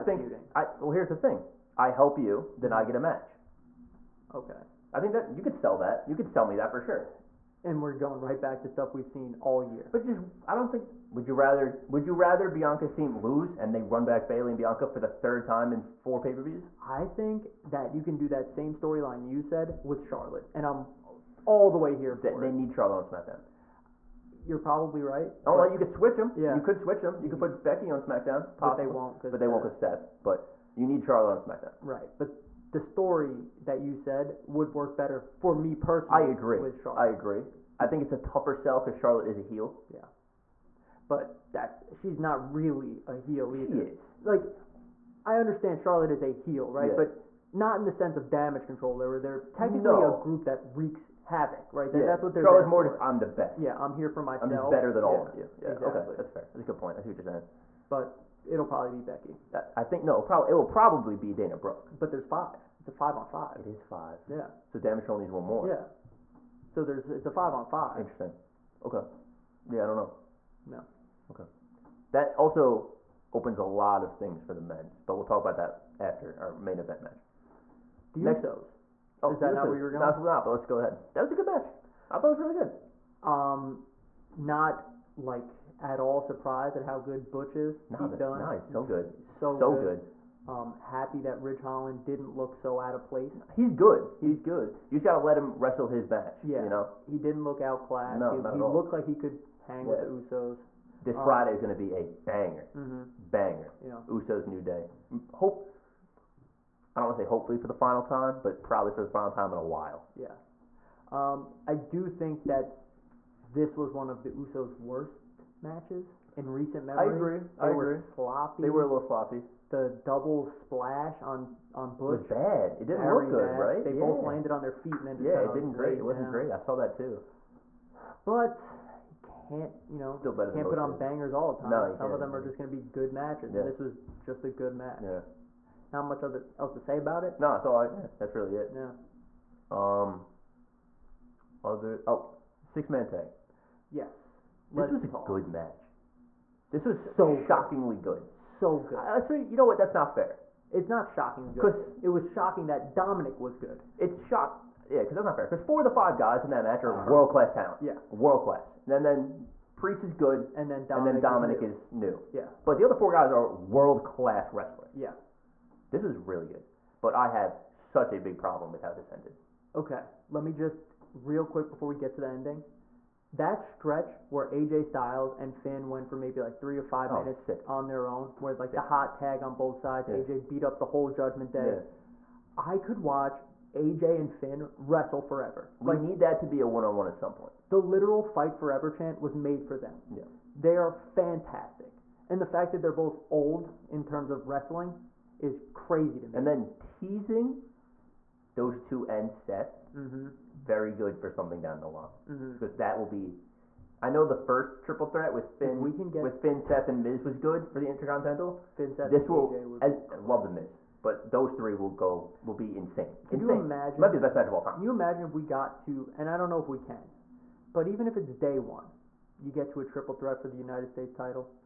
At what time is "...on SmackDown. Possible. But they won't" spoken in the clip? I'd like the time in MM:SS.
00:27.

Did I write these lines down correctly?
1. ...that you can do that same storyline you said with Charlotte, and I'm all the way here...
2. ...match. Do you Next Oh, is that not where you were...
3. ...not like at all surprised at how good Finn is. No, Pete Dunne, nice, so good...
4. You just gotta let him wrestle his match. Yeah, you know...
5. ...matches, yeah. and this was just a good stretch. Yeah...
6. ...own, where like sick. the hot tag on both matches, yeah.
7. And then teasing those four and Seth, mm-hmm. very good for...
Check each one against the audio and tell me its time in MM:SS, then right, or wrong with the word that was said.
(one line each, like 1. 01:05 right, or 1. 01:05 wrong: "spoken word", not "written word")
1. 00:17 right
2. 01:17 right
3. 01:24 wrong: "Butch", not "Finn"
4. 01:34 right
5. 02:13 wrong: "match", not "stretch"
6. 02:58 wrong: "sides", not "matches"
7. 03:16 wrong: "two", not "four".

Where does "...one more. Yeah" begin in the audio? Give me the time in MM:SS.
01:05.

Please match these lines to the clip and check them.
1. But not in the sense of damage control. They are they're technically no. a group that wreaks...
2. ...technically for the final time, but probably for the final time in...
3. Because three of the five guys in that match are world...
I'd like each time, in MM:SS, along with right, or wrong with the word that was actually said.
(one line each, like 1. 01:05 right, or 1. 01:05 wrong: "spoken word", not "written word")
1. 00:46 right
2. 01:47 wrong: "hopefully", not "technically"
3. 02:35 wrong: "four", not "three".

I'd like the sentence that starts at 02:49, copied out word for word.
Okay, let me just real quick before we get to the ending.